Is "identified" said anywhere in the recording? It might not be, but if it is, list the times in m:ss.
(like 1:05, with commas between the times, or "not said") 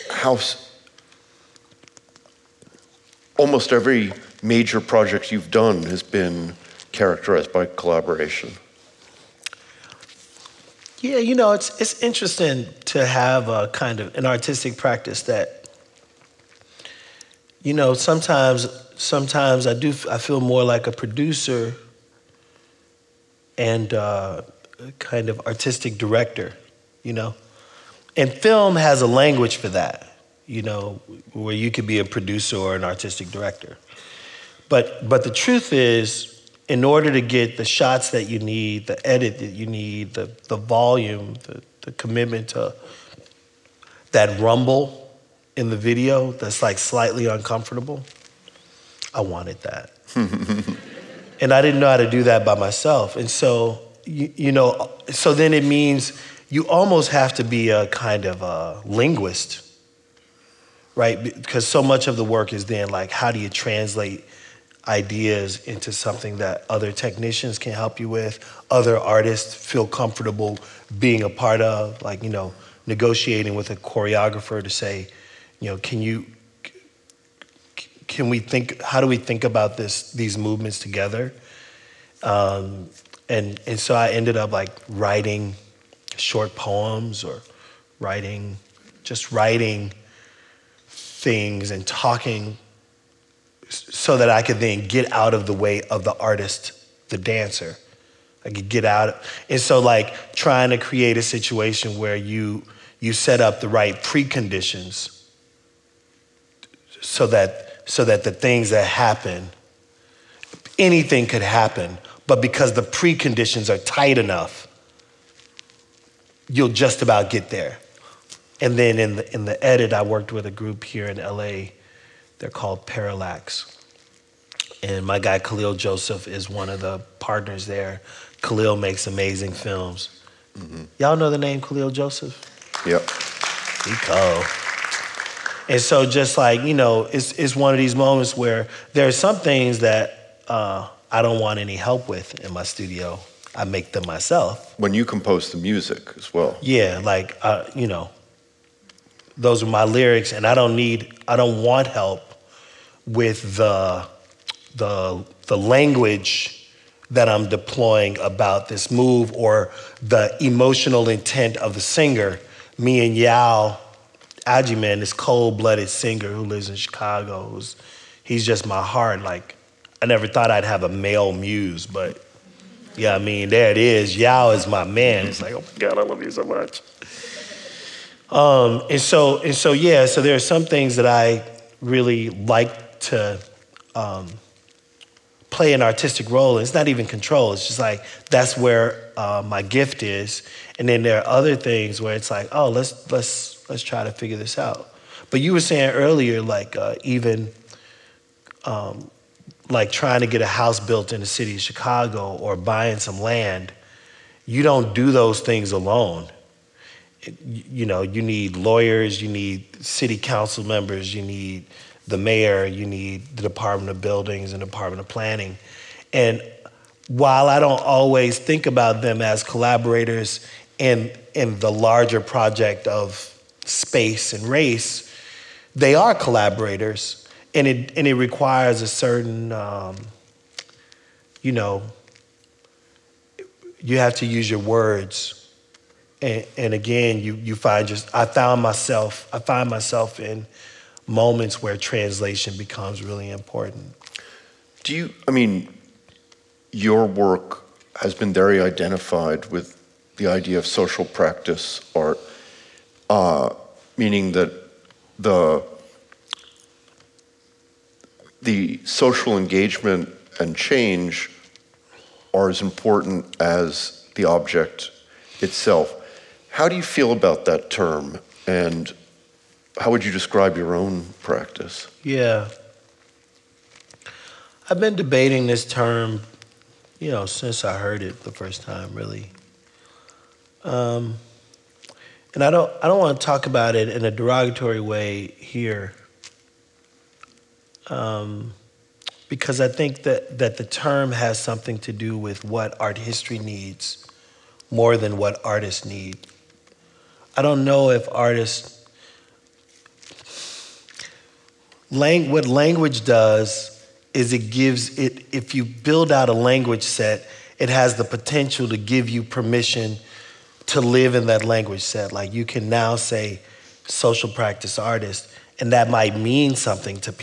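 4:08.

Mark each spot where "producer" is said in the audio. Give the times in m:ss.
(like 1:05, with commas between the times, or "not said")
0:20, 0:32.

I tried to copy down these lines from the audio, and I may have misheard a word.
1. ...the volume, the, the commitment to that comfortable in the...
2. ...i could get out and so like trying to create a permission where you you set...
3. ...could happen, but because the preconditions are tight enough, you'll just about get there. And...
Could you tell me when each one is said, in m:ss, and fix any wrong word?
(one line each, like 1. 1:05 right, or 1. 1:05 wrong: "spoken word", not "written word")
1. 0:40 wrong: "rumble", not "comfortable"
2. 1:38 wrong: "situation", not "permission"
3. 1:51 right.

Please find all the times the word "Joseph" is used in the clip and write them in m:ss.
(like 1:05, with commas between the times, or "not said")
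2:05, 2:11.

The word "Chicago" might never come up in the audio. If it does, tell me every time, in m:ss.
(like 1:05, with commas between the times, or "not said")
2:46, 3:21.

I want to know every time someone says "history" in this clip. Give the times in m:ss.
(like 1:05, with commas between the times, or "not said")
4:52.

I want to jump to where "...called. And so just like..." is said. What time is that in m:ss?
2:14.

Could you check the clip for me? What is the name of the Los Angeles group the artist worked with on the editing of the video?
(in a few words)
Parallax.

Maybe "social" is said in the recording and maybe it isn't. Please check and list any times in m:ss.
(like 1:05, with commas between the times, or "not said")
4:10, 4:18, 5:13.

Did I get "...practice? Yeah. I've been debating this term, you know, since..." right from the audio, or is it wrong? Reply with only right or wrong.
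right.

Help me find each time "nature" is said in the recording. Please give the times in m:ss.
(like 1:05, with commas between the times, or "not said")
not said.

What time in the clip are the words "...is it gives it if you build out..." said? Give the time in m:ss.
5:04.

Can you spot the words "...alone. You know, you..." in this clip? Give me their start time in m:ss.
3:25.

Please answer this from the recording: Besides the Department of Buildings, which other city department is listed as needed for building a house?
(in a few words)
Department of Planning.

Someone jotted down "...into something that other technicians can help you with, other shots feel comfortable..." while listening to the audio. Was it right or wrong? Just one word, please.
wrong.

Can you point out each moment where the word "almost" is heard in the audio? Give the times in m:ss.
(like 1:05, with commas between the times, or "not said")
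0:03, 0:56.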